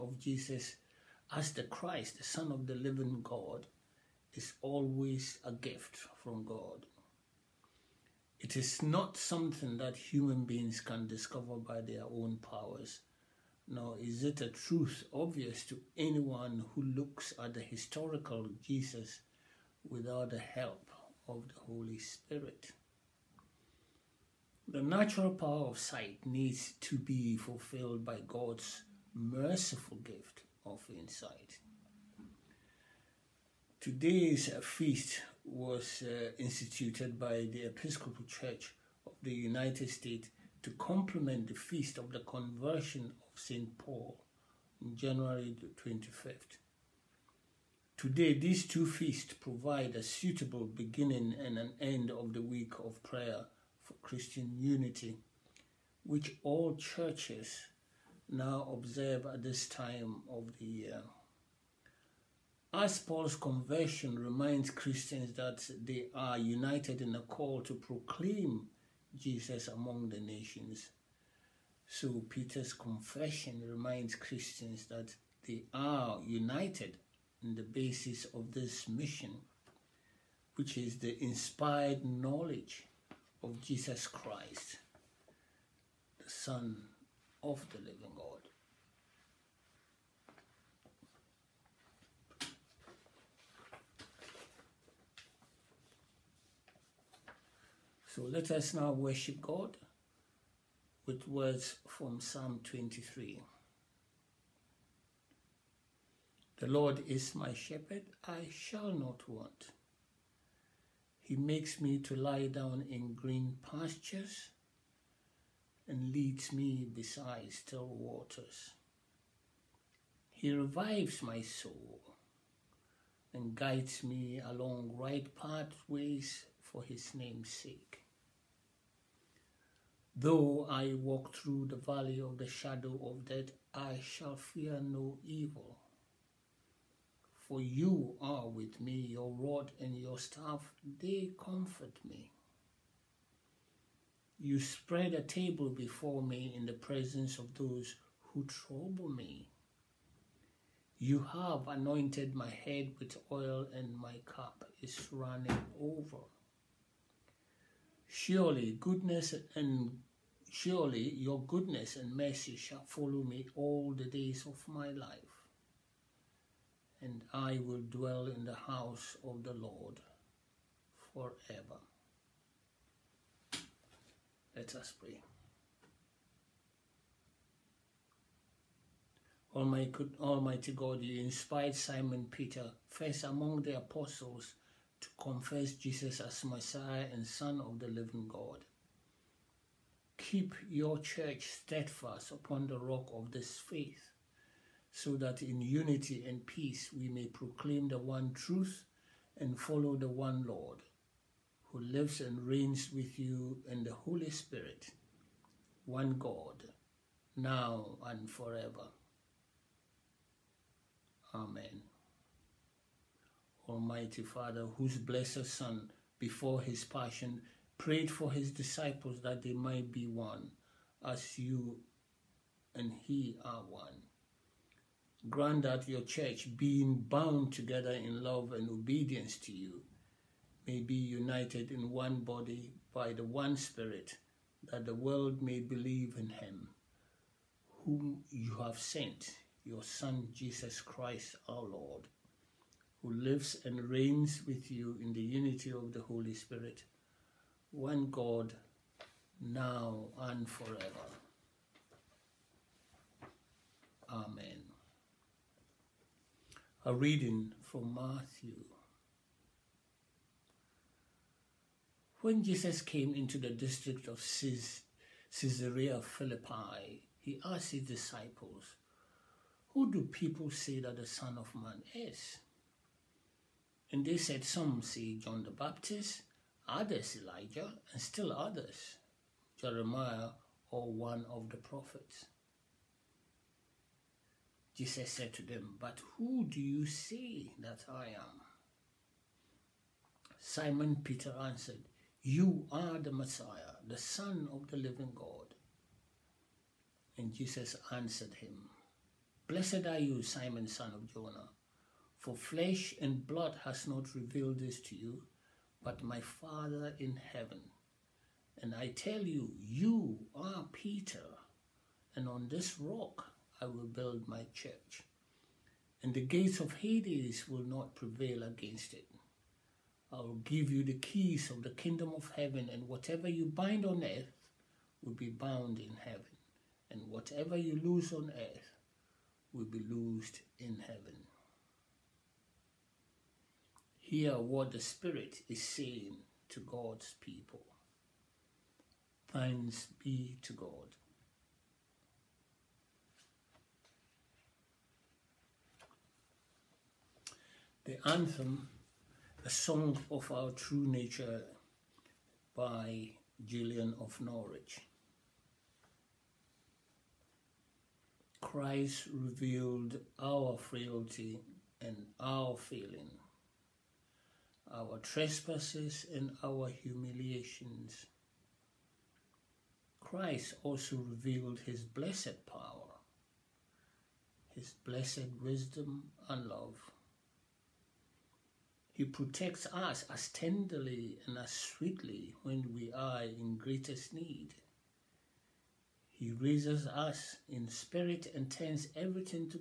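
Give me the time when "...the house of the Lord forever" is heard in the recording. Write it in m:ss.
2:48.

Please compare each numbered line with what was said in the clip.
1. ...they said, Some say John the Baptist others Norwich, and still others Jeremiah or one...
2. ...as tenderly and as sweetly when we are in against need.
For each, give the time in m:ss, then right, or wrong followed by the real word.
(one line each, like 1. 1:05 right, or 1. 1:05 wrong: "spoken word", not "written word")
1. 4:34 wrong: "Elijah", not "Norwich"
2. 6:20 wrong: "greatest", not "against".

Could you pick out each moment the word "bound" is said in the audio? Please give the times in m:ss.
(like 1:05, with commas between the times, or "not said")
3:47, 5:25.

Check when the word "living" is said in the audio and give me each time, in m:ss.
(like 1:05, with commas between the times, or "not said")
0:02, 1:27, 3:07, 4:54.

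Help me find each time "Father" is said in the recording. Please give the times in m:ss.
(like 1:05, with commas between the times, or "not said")
3:34, 5:06.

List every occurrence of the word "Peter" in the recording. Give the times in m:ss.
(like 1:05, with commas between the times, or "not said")
1:12, 3:02, 4:51, 5:10.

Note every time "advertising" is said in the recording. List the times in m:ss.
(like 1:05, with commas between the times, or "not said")
not said.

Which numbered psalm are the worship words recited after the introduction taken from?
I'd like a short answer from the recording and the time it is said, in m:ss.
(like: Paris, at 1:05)
Psalm 23, at 1:42.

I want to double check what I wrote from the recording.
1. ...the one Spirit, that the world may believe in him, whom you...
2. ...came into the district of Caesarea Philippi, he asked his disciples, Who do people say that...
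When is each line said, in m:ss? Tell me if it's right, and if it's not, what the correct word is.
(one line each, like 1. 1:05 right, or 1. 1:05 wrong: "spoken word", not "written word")
1. 3:53 right
2. 4:22 right.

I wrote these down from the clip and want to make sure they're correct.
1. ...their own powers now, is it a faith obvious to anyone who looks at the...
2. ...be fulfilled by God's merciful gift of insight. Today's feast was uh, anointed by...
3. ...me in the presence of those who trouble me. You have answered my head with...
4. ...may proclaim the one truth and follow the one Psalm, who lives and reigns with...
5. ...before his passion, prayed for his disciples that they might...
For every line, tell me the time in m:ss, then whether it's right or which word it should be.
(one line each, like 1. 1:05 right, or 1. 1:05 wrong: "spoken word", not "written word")
1. 0:11 wrong: "truth", not "faith"
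2. 0:26 wrong: "instituted", not "anointed"
3. 2:26 wrong: "anointed", not "answered"
4. 3:17 wrong: "Lord", not "Psalm"
5. 3:36 right.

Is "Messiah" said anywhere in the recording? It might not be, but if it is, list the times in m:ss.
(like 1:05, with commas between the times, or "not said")
3:06, 4:53.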